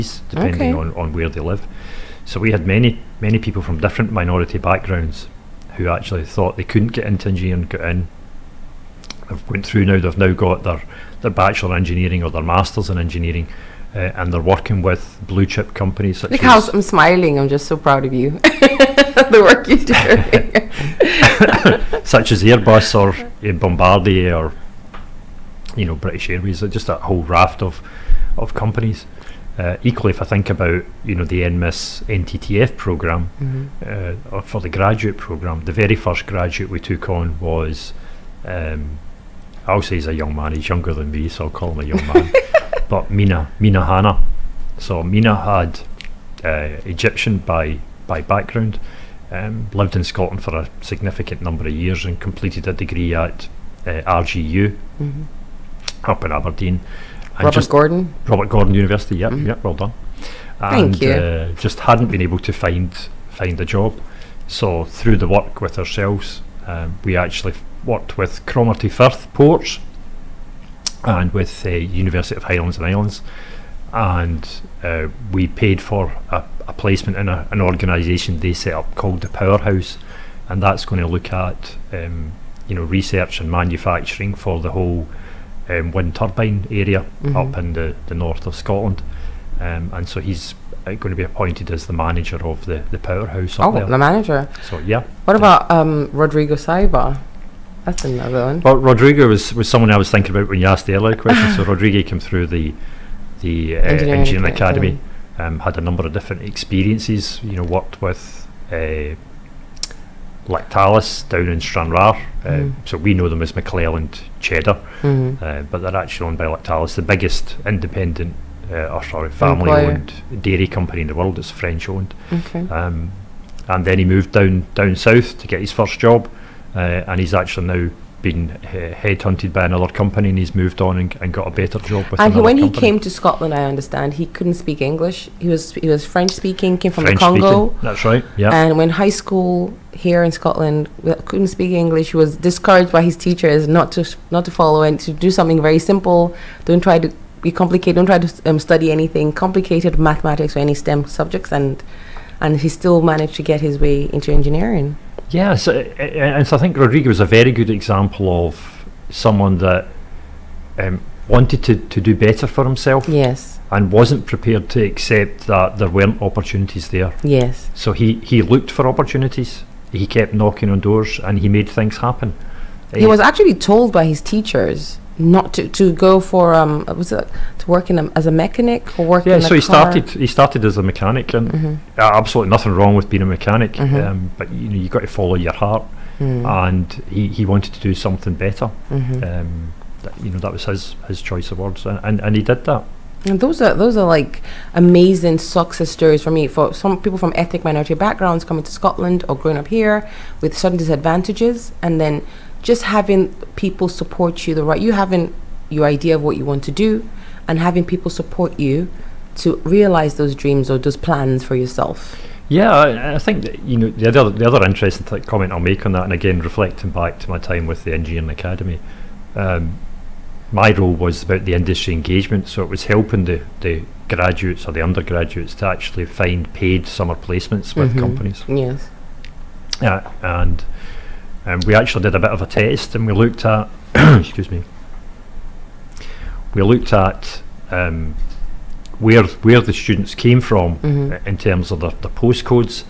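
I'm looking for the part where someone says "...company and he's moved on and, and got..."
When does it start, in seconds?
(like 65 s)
129 s.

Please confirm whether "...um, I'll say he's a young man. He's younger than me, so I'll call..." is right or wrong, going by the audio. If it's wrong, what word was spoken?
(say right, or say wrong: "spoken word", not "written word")
right.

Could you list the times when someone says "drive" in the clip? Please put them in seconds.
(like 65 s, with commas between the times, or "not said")
not said.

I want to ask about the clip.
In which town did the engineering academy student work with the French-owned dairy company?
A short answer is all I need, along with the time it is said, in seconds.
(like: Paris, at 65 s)
Stranraer, at 111 s.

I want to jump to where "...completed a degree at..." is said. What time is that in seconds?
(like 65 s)
52 s.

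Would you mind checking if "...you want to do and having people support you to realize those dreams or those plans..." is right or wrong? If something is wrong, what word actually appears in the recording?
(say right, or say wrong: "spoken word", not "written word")
right.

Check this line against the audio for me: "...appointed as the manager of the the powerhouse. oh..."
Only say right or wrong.
right.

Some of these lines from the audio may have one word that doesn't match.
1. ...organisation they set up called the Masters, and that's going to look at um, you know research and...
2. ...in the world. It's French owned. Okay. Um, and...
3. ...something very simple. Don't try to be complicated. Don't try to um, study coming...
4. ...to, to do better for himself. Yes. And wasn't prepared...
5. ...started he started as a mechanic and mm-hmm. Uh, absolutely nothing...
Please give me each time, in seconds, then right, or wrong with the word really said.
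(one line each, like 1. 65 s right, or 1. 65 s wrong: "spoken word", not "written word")
1. 77 s wrong: "Powerhouse", not "Masters"
2. 121 s right
3. 145 s wrong: "anything", not "coming"
4. 161 s right
5. 179 s right.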